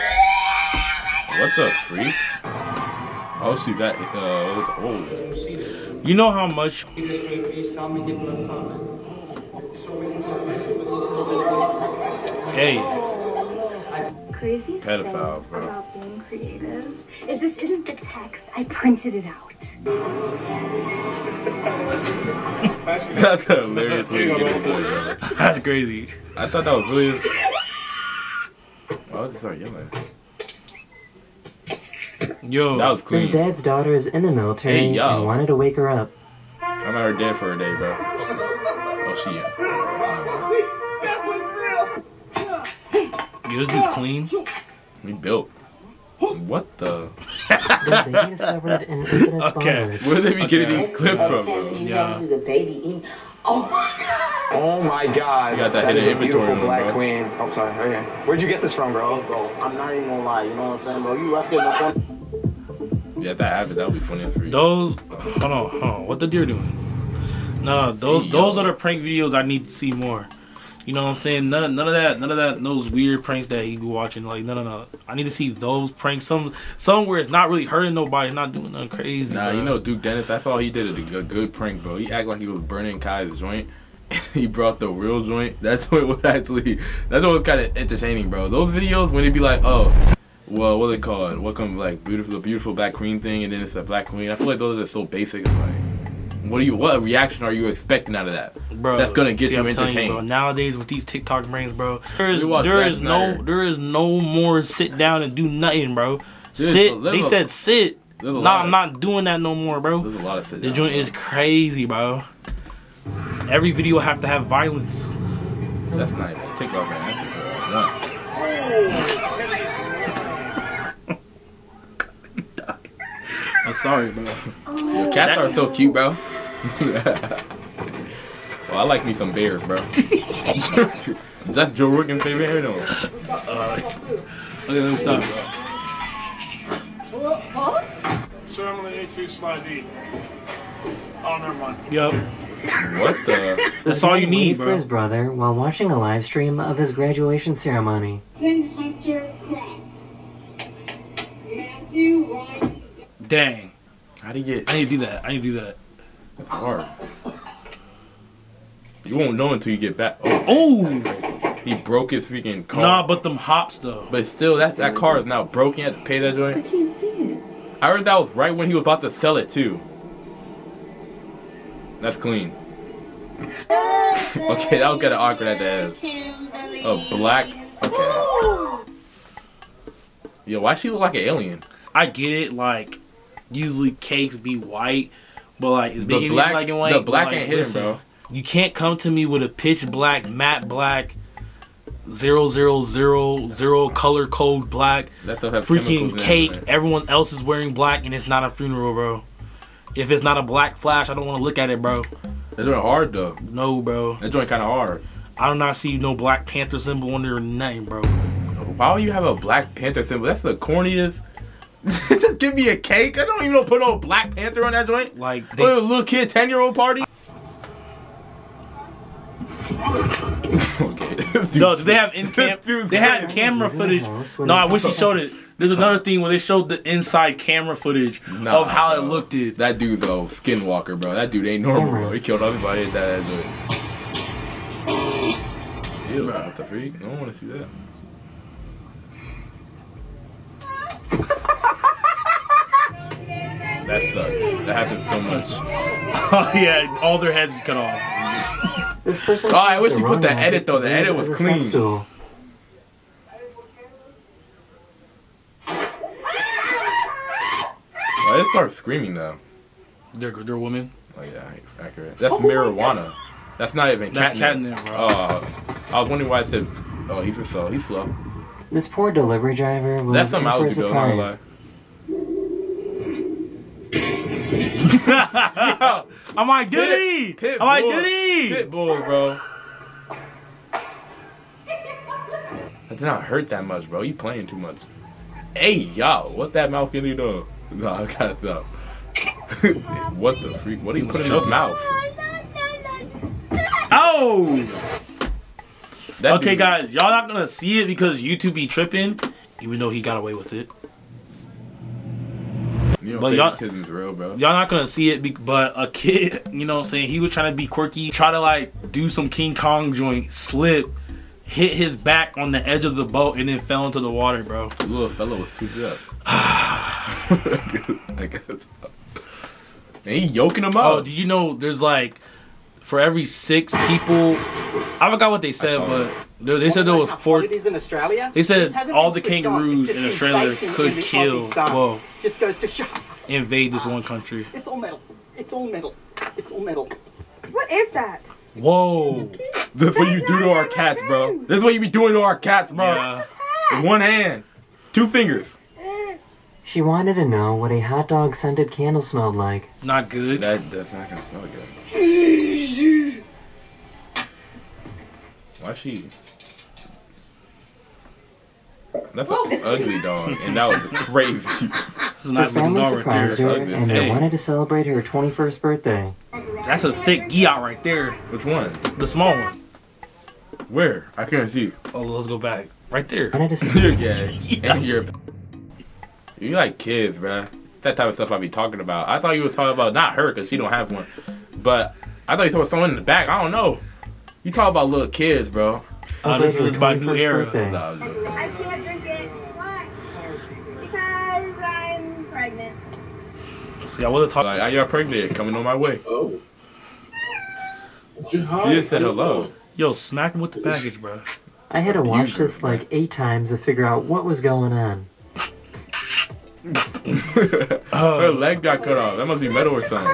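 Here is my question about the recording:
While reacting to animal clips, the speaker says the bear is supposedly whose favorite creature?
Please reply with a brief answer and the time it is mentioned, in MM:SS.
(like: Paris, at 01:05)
Joe Rogan, at 02:11.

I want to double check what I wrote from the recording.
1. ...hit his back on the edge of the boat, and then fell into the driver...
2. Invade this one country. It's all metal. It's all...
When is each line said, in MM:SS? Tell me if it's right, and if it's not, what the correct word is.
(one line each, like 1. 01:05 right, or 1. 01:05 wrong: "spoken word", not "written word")
1. 05:11 wrong: "water", not "driver"
2. 05:33 right.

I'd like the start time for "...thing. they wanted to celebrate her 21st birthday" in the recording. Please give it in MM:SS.
06:03.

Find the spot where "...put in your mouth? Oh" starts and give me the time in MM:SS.
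04:51.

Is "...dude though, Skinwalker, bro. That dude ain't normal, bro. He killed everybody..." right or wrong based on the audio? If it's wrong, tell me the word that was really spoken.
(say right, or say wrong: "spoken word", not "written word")
right.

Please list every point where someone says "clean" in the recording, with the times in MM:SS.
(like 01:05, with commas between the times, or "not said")
00:33, 00:43, 02:52, 04:11.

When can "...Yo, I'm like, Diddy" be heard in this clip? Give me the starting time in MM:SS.
04:35.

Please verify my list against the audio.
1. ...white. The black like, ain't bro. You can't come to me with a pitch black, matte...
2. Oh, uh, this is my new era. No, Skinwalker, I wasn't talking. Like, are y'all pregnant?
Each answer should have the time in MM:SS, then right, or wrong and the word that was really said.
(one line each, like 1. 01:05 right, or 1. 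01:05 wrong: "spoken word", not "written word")
1. 03:06 right
2. 06:26 wrong: "See", not "Skinwalker".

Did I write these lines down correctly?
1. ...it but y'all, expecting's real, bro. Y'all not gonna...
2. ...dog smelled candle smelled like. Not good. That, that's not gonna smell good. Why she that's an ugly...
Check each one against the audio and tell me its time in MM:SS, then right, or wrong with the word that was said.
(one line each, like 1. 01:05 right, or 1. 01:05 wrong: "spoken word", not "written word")
1. 05:00 wrong: "kidding", not "expecting"
2. 05:48 wrong: "scented", not "smelled".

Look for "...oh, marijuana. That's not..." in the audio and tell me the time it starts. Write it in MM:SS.
04:22.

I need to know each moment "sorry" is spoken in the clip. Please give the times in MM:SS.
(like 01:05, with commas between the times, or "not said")
00:57, 02:03.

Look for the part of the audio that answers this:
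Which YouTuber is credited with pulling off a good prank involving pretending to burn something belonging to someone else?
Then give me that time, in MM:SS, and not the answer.
01:19.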